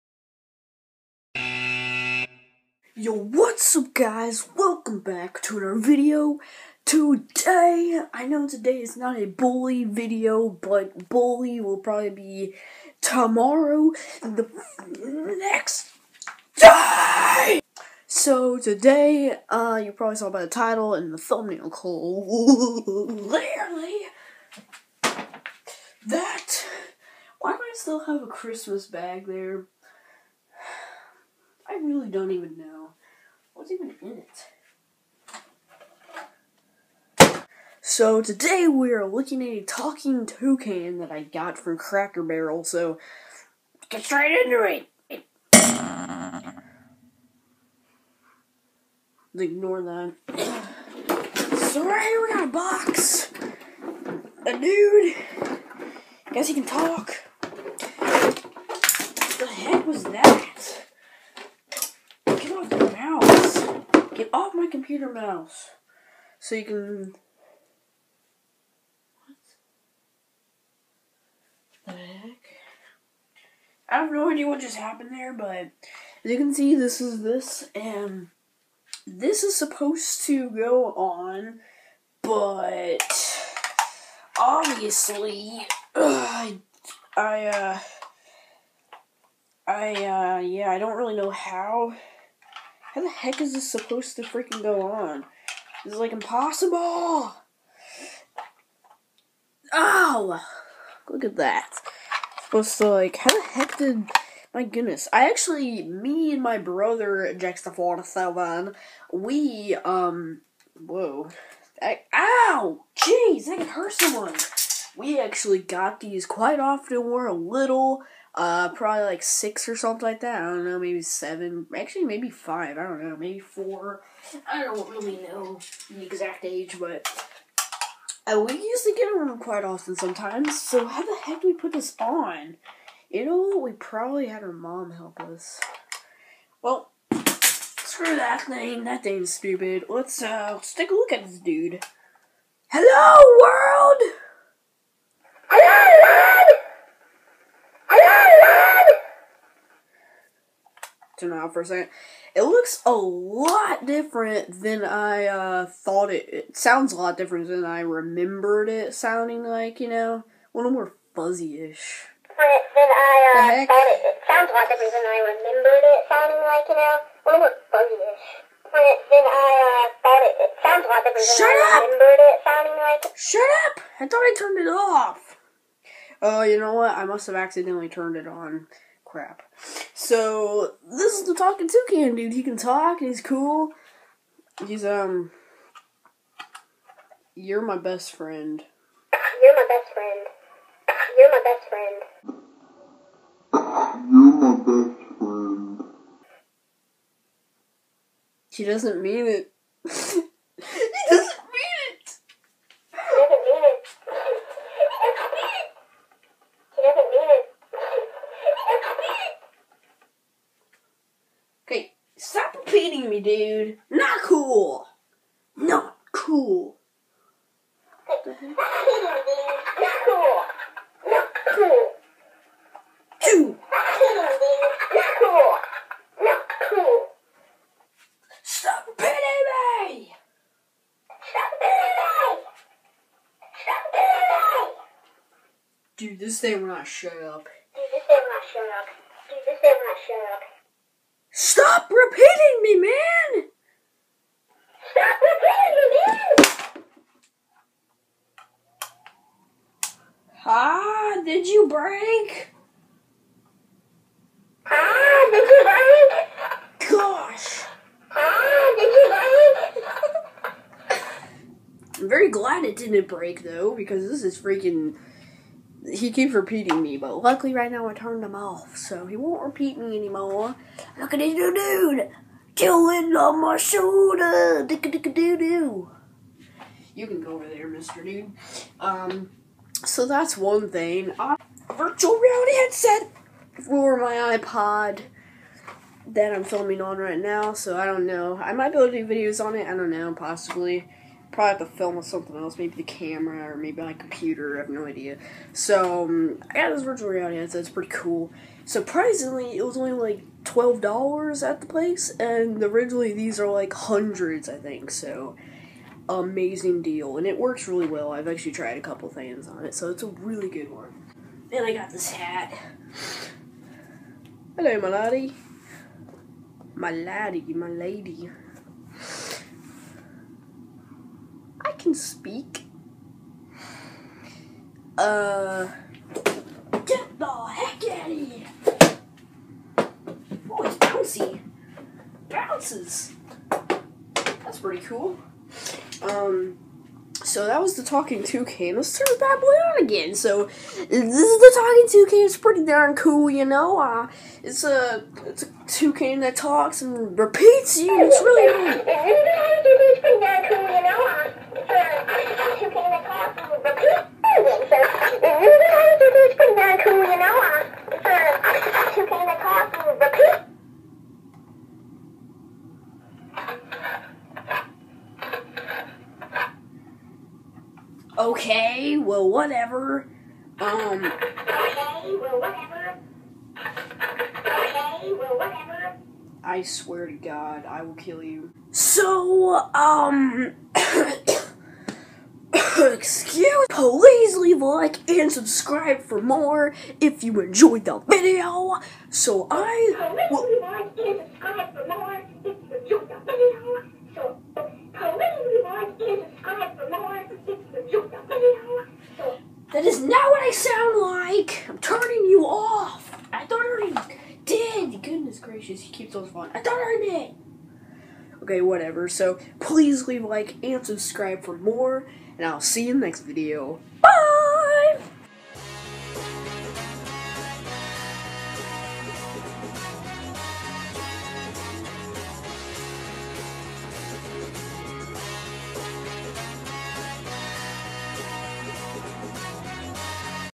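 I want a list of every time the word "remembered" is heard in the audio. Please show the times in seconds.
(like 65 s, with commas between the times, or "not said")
157 s, 165 s, 171 s.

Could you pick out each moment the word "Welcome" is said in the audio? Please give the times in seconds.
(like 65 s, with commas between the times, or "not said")
4 s.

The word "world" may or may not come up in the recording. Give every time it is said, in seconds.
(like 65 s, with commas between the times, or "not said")
143 s.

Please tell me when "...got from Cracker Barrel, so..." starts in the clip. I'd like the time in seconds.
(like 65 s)
41 s.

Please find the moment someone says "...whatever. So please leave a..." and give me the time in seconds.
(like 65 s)
408 s.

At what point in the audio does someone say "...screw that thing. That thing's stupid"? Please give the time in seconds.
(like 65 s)
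137 s.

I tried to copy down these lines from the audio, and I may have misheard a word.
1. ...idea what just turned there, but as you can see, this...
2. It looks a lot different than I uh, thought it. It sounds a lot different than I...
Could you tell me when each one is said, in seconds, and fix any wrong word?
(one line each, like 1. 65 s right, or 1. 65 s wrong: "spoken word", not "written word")
1. 74 s wrong: "happened", not "turned"
2. 152 s right.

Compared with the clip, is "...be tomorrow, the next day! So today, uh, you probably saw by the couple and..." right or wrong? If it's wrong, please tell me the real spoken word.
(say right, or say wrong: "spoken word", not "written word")
wrong: "title", not "couple".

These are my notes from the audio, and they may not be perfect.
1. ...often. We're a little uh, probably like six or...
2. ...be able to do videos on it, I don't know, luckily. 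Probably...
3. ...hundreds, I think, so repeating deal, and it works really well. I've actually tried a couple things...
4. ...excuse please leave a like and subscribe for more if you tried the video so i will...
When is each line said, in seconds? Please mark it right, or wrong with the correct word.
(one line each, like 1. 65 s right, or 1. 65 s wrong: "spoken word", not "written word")
1. 116 s right
2. 288 s wrong: "possibly", not "luckily"
3. 303 s wrong: "amazing", not "repeating"
4. 382 s wrong: "enjoyed", not "tried".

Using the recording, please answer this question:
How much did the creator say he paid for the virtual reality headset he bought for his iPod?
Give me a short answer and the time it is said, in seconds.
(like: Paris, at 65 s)
$12, at 300 s.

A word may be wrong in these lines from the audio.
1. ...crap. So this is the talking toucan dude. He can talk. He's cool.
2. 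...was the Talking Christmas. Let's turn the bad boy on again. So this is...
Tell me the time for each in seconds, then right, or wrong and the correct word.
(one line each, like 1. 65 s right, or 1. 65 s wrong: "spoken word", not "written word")
1. 179 s right
2. 337 s wrong: "Toucan", not "Christmas".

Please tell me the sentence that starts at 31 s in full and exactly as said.
really don't even know what's even in it.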